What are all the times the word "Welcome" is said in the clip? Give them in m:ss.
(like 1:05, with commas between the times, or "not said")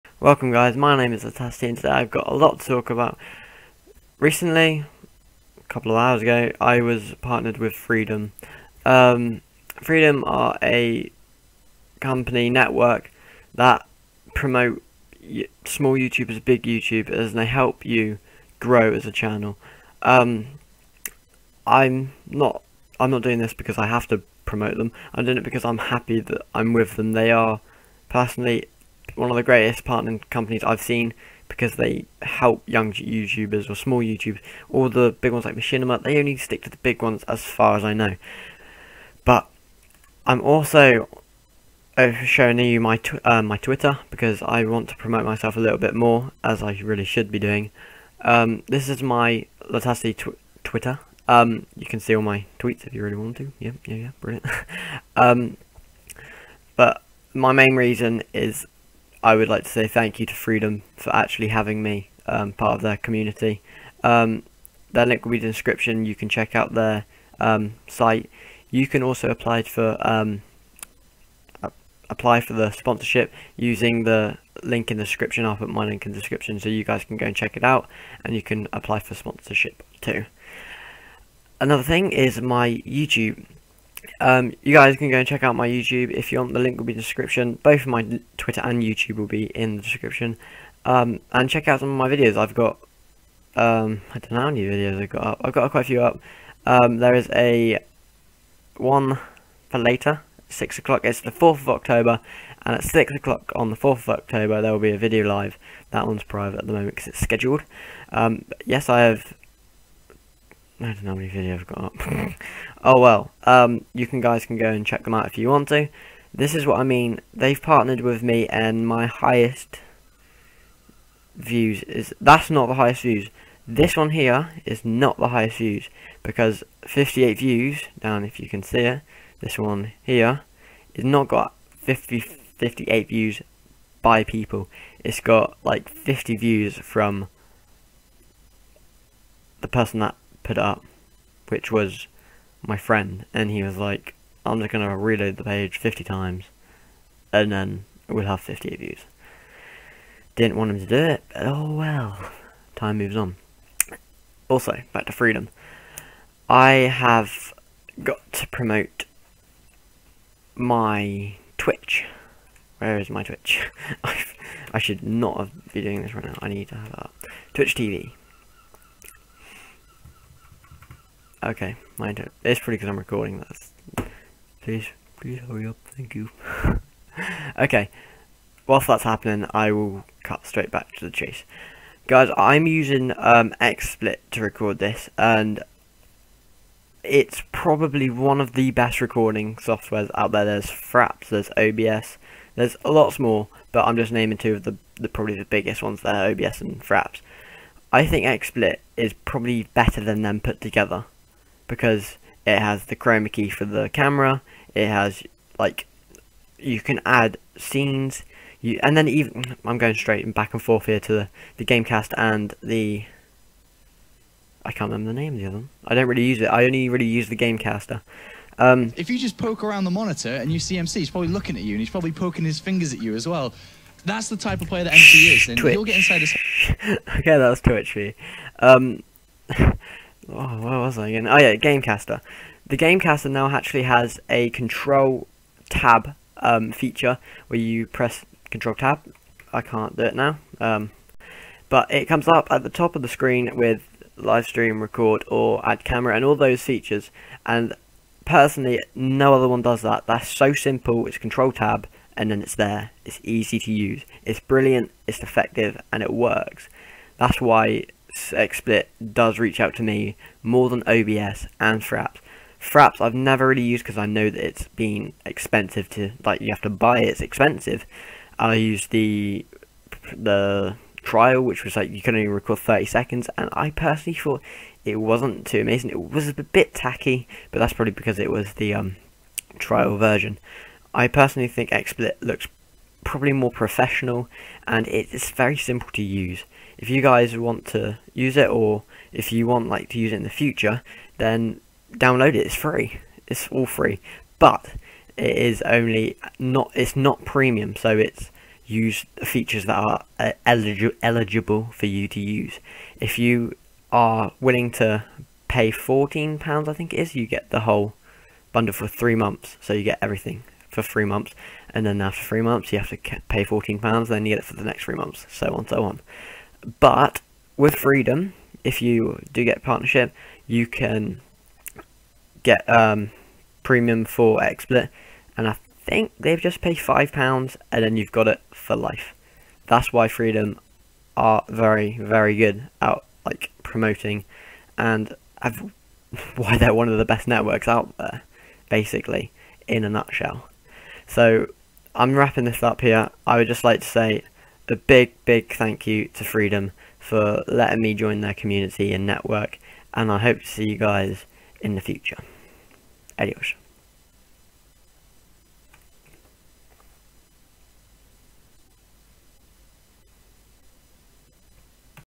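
0:00.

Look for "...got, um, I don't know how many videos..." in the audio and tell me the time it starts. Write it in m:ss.
1:32.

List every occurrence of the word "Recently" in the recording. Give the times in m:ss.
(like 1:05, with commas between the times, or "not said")
0:04.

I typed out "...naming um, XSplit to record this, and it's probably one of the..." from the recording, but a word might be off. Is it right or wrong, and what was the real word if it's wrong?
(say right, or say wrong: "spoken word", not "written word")
wrong: "using", not "naming".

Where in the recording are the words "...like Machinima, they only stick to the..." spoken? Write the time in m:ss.
0:35.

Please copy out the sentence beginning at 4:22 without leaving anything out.
Fraps I've never really used because I know that it's been expensive to like you have to buy it, it's expensive.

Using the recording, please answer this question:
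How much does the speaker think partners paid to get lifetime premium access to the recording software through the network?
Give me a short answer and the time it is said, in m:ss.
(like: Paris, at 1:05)
5 pounds, at 5:26.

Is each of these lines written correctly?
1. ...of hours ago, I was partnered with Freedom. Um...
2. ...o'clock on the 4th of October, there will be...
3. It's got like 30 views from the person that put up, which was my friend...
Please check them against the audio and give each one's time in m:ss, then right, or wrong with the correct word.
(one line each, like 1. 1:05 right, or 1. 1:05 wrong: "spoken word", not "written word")
1. 0:05 right
2. 1:43 right
3. 2:15 wrong: "50", not "30".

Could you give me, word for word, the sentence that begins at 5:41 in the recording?
So I'm wrapping this up here.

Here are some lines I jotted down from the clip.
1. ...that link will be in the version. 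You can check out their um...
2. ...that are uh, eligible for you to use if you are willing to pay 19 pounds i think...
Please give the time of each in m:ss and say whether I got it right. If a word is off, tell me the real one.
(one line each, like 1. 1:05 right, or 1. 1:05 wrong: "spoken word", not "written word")
1. 1:04 wrong: "description", not "version"
2. 4:59 wrong: "14", not "19".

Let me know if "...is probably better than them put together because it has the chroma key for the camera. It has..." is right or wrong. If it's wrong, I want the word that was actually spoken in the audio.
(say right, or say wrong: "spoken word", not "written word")
right.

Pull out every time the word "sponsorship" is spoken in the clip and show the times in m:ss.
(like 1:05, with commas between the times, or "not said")
1:12, 1:19.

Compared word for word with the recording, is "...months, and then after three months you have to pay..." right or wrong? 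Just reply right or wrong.
right.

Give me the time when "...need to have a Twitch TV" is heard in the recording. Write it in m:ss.
2:46.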